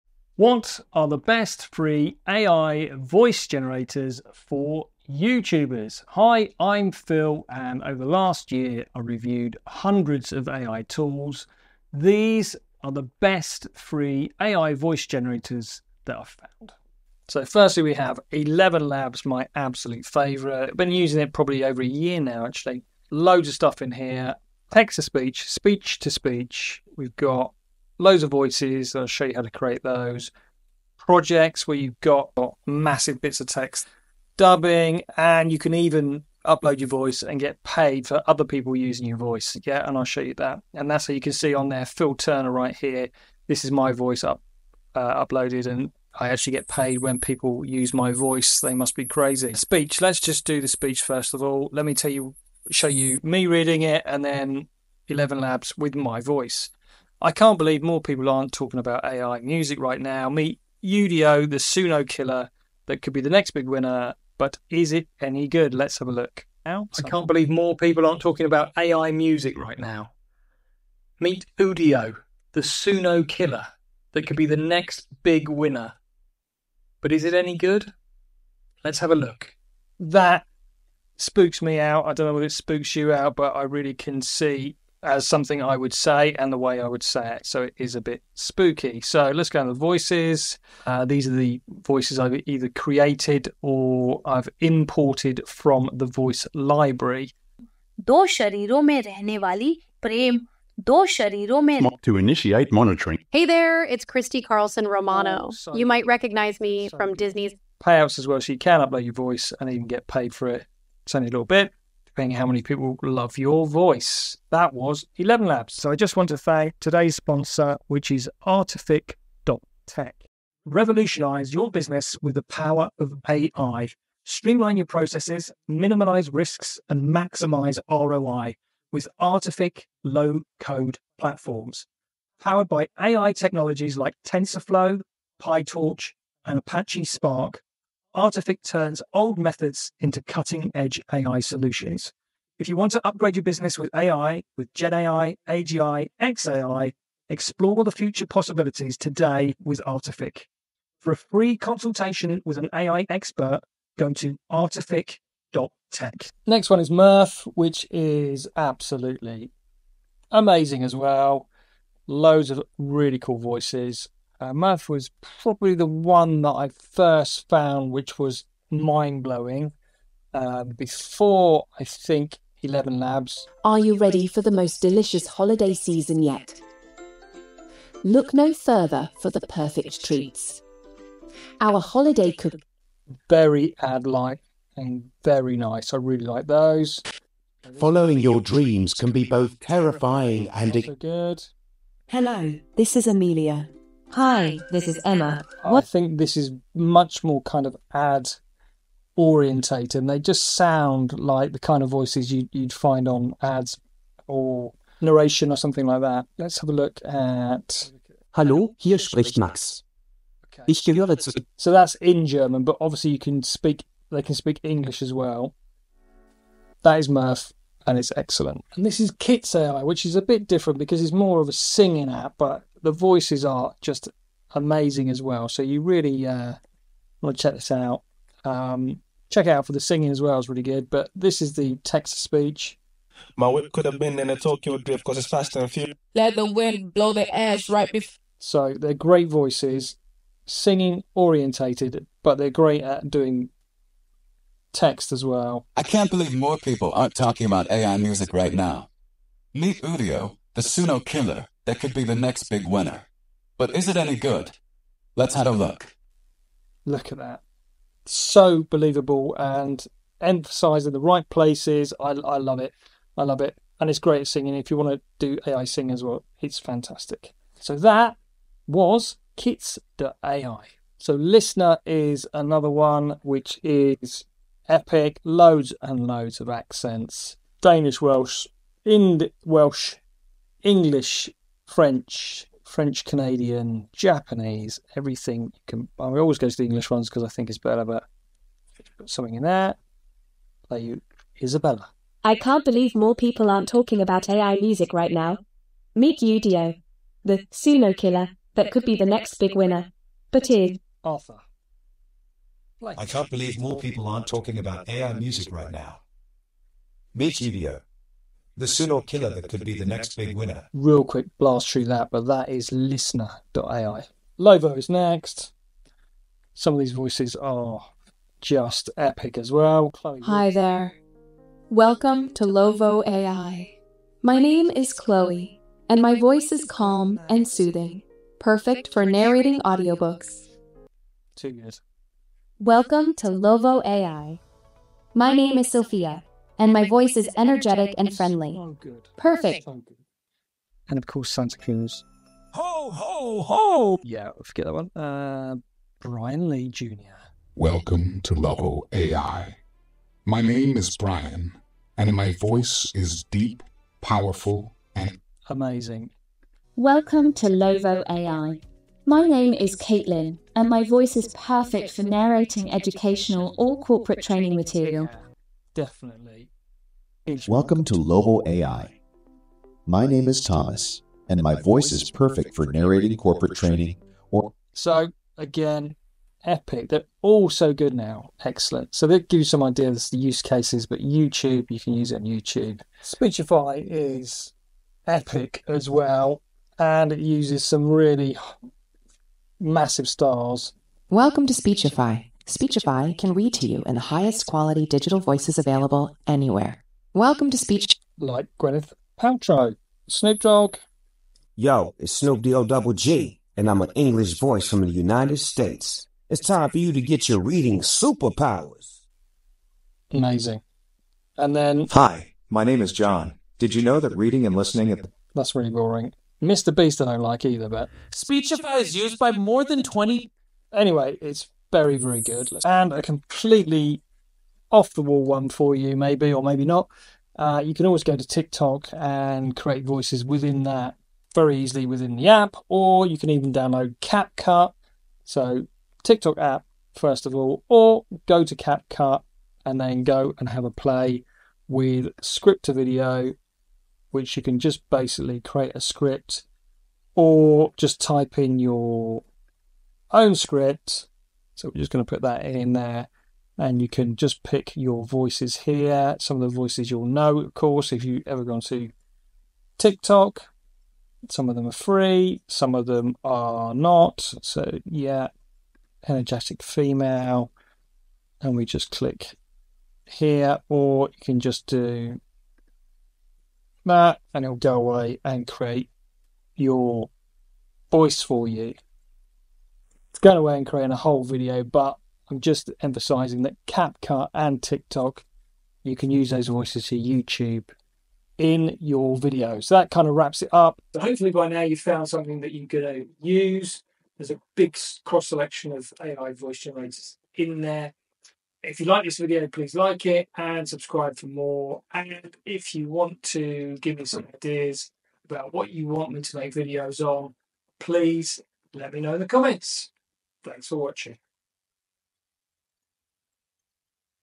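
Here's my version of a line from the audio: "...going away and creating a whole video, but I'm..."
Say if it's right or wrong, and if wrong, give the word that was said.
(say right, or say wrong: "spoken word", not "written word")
right.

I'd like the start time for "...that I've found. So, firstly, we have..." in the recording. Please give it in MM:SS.
00:16.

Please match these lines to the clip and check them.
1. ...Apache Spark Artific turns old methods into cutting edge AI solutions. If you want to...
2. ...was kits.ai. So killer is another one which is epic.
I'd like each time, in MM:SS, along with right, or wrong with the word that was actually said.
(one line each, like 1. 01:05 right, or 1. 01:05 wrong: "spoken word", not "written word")
1. 02:16 right
2. 04:28 wrong: "listener", not "killer".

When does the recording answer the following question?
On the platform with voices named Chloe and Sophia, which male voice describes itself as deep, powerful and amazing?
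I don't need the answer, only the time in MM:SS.
05:46.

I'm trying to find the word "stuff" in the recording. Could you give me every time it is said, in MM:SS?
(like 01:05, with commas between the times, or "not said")
00:23.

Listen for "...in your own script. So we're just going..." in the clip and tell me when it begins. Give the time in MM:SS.
07:28.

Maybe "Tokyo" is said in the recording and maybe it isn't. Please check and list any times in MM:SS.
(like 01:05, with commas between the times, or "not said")
03:54.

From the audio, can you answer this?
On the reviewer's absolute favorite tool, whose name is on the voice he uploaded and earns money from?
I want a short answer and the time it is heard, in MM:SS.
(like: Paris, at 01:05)
Phil Turner, at 00:41.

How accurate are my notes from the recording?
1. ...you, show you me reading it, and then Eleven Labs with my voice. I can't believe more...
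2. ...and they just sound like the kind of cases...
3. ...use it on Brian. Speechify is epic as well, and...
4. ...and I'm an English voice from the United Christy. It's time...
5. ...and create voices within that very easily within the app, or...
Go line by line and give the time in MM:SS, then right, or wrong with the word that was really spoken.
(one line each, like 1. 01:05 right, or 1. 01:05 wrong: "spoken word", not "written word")
1. 00:52 right
2. 03:20 wrong: "voices", not "cases"
3. 06:21 wrong: "YouTube", not "Brian"
4. 06:43 wrong: "States", not "Christy"
5. 07:08 right.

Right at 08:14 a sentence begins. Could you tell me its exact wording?
There's a big cross selection of AI voice generators in there.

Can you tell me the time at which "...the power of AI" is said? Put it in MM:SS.
02:02.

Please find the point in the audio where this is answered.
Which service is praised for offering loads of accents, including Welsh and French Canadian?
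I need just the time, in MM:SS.
05:12.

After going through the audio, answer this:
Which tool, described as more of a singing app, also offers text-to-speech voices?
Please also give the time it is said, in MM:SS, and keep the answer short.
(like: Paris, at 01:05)
Kits AI, at 03:39.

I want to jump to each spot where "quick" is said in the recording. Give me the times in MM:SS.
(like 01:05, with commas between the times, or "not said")
05:11.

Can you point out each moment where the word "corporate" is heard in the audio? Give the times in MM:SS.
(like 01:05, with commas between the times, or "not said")
06:03, 06:13.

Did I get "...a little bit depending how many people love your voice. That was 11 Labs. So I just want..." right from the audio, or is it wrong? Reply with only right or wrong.
right.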